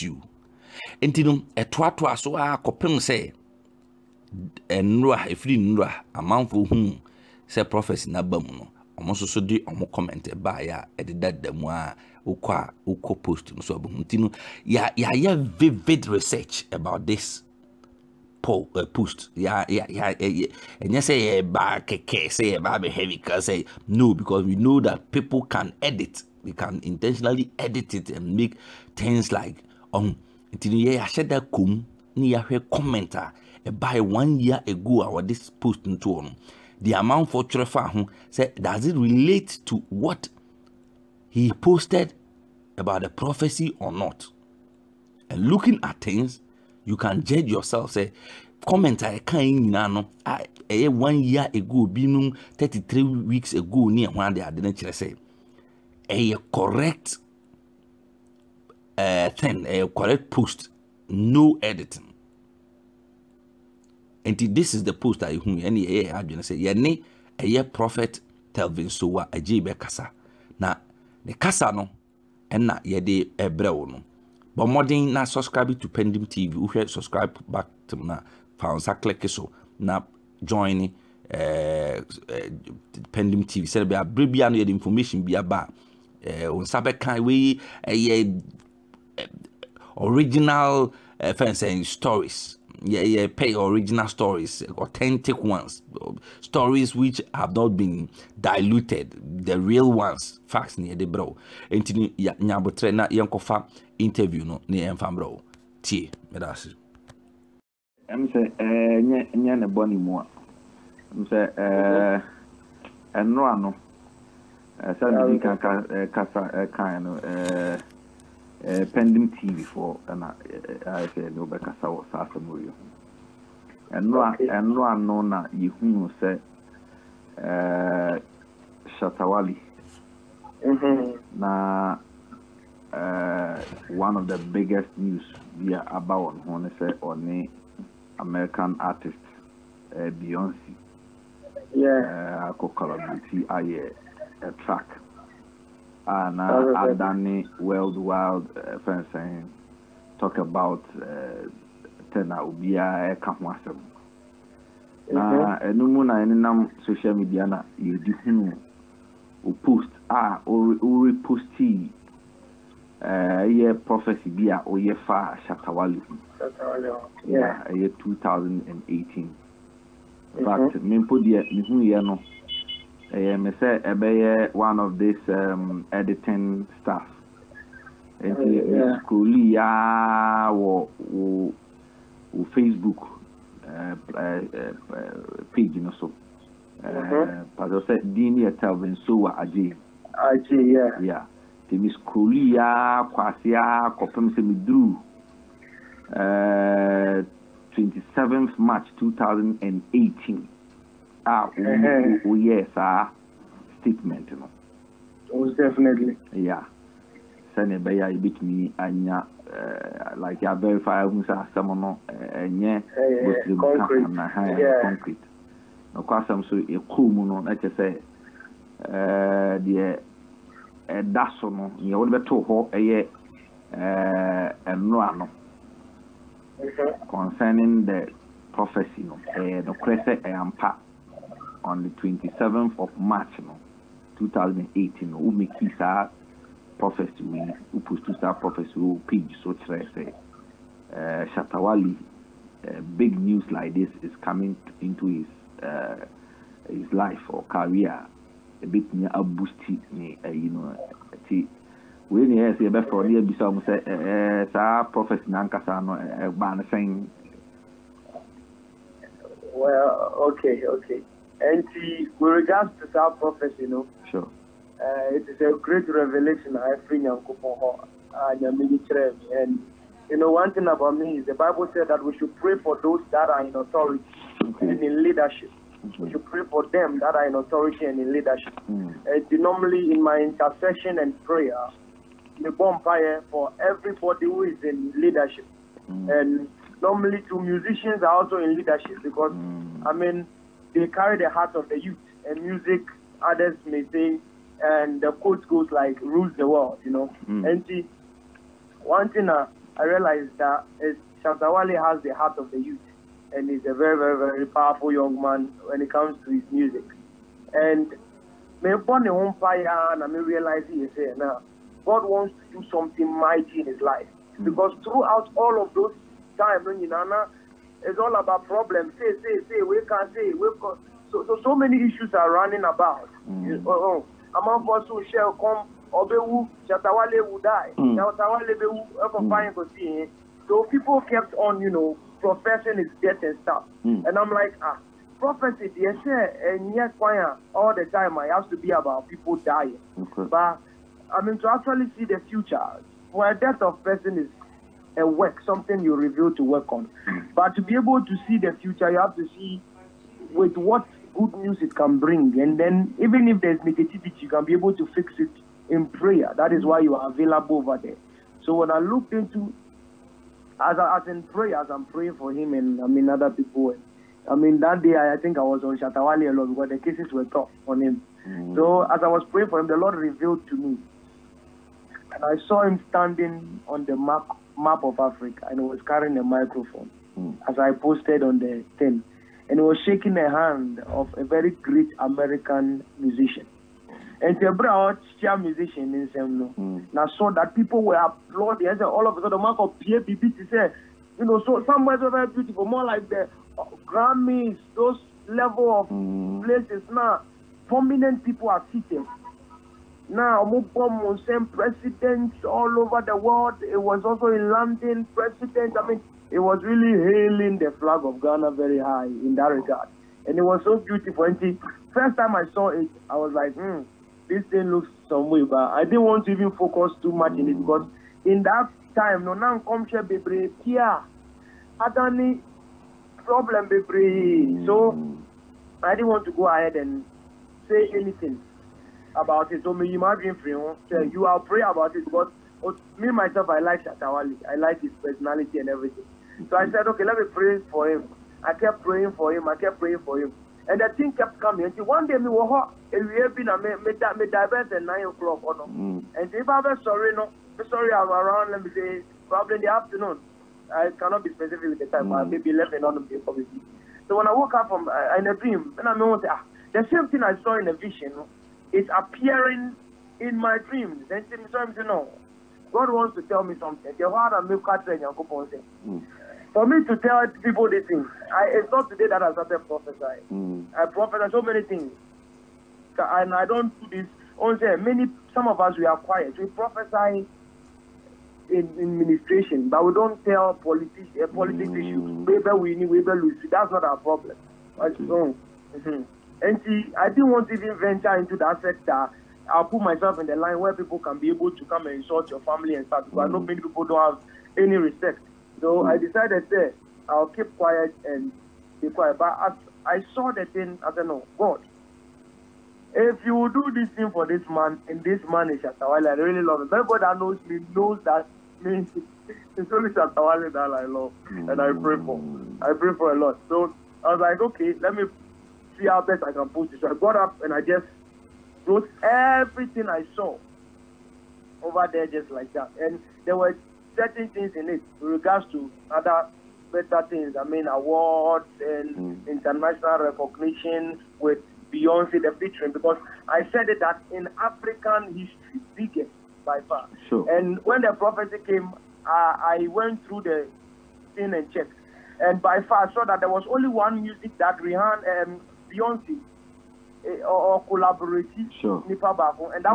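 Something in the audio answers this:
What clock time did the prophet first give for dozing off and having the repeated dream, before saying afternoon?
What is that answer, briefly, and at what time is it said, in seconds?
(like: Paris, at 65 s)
Nine o'clock, at 444 s.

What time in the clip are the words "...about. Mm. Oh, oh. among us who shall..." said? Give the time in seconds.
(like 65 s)
322 s.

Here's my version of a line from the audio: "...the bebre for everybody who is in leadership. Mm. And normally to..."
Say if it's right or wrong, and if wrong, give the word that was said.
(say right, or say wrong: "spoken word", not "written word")
wrong: "bonfire", not "bebre".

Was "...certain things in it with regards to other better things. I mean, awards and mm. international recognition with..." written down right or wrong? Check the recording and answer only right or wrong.
right.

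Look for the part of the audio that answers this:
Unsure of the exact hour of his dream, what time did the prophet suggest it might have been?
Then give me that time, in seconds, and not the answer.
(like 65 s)
452 s.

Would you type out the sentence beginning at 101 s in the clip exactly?
Enti nyabotre na yankofa interview no ne yɛmfa bro.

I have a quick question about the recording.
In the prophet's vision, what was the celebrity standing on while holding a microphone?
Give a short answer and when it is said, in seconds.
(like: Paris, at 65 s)
Map of Africa, at 374 s.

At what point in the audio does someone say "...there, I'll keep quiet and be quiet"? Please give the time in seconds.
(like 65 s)
496 s.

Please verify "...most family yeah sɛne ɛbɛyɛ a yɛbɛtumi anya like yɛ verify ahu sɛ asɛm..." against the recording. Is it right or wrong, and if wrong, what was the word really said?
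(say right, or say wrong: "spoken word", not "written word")
wrong: "definitely", not "family".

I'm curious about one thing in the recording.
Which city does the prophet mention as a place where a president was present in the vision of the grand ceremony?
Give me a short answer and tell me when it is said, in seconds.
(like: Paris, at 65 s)
London, at 404 s.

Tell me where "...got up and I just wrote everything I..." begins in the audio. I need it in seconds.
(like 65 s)
516 s.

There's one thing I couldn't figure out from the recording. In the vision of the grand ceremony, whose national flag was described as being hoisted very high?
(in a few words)
Ghana.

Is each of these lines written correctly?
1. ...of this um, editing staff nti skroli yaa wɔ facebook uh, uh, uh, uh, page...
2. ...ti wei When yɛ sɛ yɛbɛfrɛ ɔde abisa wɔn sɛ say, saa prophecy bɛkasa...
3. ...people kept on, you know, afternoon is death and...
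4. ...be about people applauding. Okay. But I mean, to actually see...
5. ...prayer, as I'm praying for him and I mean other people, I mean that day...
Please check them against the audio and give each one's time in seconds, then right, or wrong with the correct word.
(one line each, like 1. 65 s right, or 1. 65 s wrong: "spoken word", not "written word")
1. 174 s right
2. 251 s wrong: "nankasa", not "bɛkasa"
3. 330 s wrong: "profession", not "afternoon"
4. 338 s wrong: "dying", not "applauding"
5. 361 s right.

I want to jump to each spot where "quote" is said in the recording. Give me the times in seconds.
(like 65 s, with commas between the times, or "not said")
295 s.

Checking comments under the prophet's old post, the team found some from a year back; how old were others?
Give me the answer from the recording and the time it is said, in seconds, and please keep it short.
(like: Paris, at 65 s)
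33 weeks ago, at 52 s.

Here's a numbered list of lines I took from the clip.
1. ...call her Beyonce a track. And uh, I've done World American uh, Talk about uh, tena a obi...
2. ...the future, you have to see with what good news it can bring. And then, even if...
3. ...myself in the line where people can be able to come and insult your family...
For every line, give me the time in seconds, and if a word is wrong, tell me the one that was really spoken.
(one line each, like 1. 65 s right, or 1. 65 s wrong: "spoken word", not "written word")
1. 142 s wrong: "Wild", not "American"
2. 348 s right
3. 489 s right.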